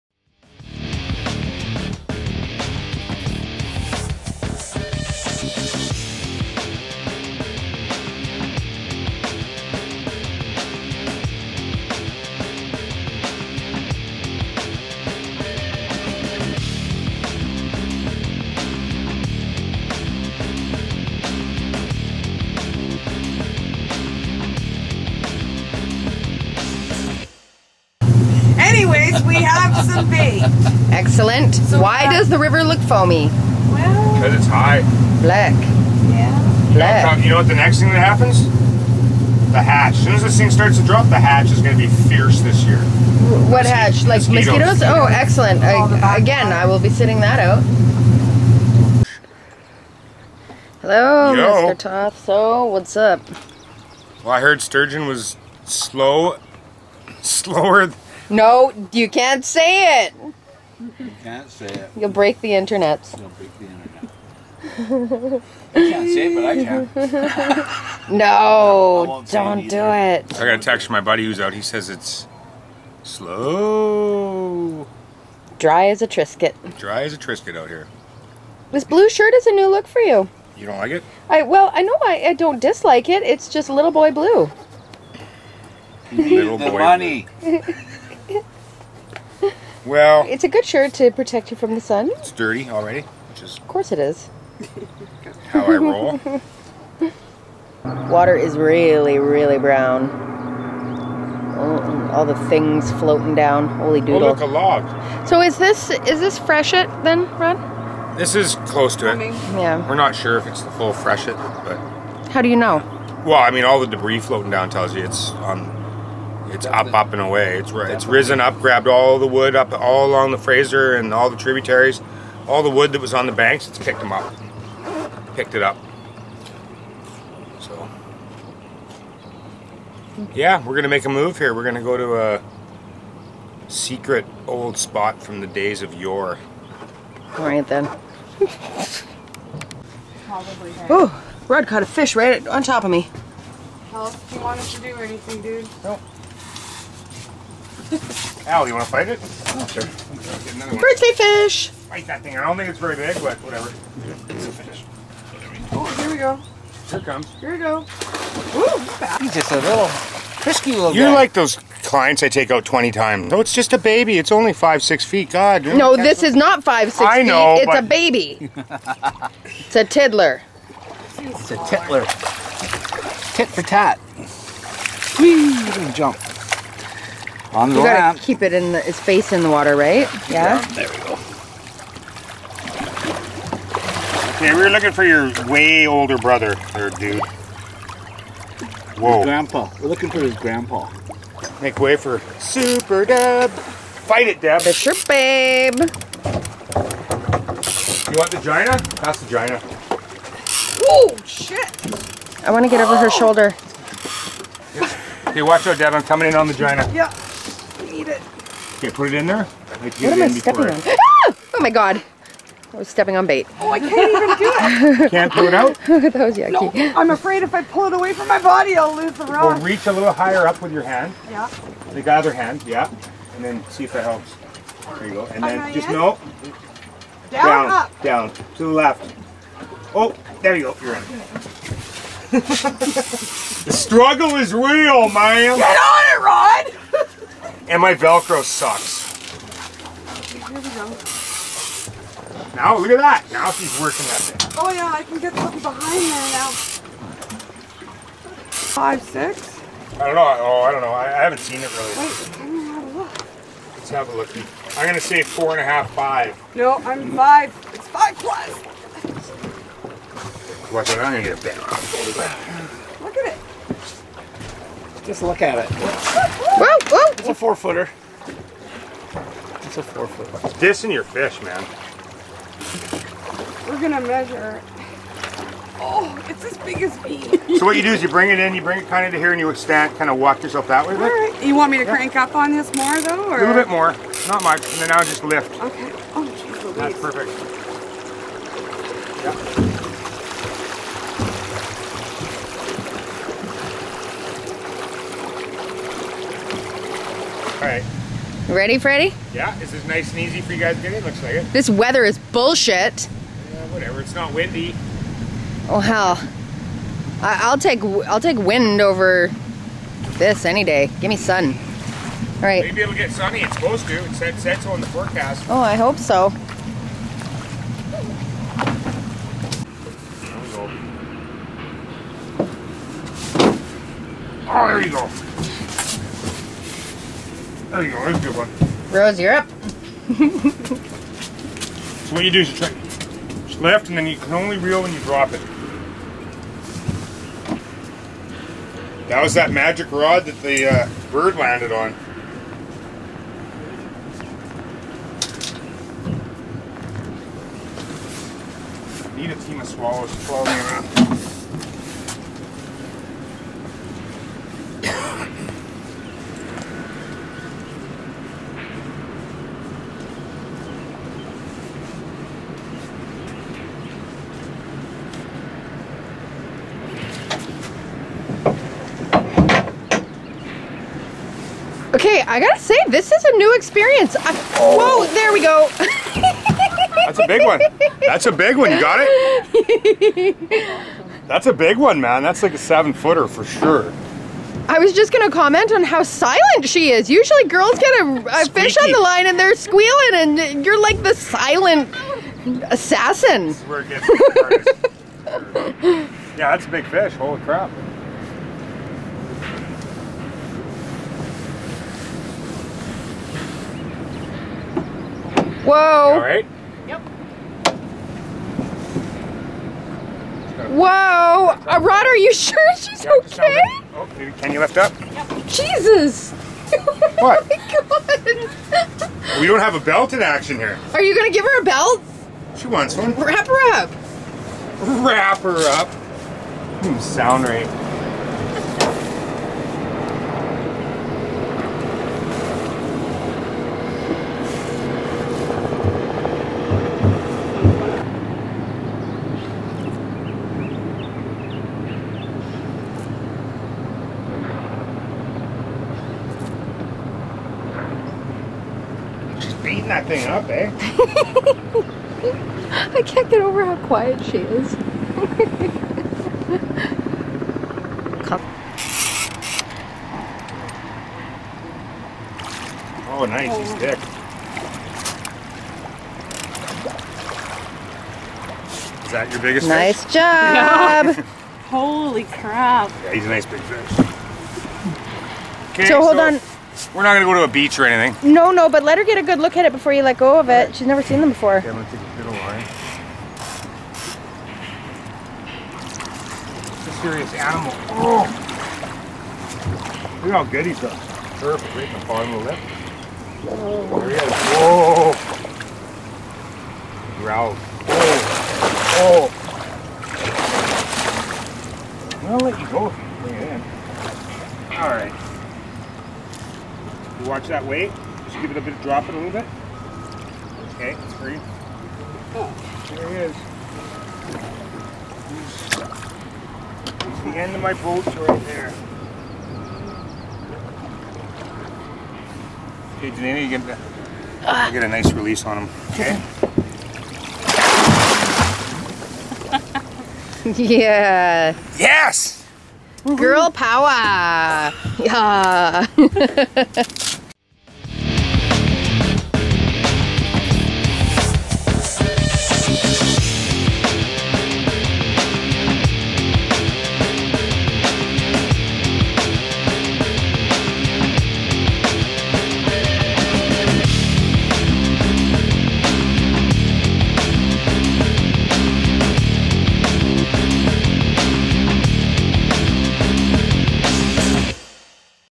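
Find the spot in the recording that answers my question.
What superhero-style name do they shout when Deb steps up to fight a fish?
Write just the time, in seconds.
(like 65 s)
191 s.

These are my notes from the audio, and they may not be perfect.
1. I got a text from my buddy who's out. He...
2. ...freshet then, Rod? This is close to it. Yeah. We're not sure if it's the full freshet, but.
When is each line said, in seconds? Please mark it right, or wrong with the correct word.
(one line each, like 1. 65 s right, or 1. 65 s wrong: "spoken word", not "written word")
1. 70 s right
2. 106 s right.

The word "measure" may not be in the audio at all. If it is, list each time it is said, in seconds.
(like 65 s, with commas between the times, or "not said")
274 s.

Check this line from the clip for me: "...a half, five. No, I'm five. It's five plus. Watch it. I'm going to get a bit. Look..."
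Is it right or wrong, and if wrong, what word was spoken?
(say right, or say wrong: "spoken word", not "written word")
right.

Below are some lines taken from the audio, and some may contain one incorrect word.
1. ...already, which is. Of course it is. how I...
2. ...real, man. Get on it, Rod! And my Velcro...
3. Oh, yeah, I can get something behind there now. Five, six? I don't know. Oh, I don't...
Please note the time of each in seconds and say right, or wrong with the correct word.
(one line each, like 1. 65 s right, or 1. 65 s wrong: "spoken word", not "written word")
1. 92 s right
2. 234 s right
3. 244 s right.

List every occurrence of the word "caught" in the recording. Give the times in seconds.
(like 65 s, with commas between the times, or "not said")
141 s.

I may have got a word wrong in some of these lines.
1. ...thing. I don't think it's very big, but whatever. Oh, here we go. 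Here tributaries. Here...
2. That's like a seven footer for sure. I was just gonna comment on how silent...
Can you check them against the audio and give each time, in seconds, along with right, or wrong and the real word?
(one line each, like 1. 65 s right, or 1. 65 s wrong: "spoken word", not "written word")
1. 152 s wrong: "comes", not "tributaries"
2. 382 s right.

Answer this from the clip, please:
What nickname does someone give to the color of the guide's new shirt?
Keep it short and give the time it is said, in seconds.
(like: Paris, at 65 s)
Little boy blue, at 83 s.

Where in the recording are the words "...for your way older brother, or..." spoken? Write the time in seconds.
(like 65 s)
184 s.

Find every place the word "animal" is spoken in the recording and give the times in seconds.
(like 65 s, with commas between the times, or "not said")
487 s.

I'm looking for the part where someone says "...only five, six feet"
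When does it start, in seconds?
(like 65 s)
164 s.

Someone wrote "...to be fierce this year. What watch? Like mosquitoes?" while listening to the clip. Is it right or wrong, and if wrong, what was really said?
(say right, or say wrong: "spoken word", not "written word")
wrong: "hatch", not "watch".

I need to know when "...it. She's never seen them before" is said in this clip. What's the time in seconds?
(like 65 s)
480 s.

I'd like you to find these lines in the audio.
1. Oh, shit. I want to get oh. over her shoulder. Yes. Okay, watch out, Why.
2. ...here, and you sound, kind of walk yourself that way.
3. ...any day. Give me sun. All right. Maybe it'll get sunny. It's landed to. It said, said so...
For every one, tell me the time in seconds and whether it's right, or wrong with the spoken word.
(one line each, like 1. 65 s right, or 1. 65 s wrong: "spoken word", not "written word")
1. 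200 s wrong: "Deb", not "Why"
2. 279 s wrong: "extend", not "sound"
3. 310 s wrong: "supposed", not "landed".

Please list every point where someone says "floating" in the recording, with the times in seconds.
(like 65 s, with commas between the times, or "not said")
103 s, 114 s.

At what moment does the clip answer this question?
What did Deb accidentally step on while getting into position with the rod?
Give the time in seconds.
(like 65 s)
212 s.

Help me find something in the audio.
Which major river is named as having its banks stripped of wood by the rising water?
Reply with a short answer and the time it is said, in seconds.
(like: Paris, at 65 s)
Fraser, at 120 s.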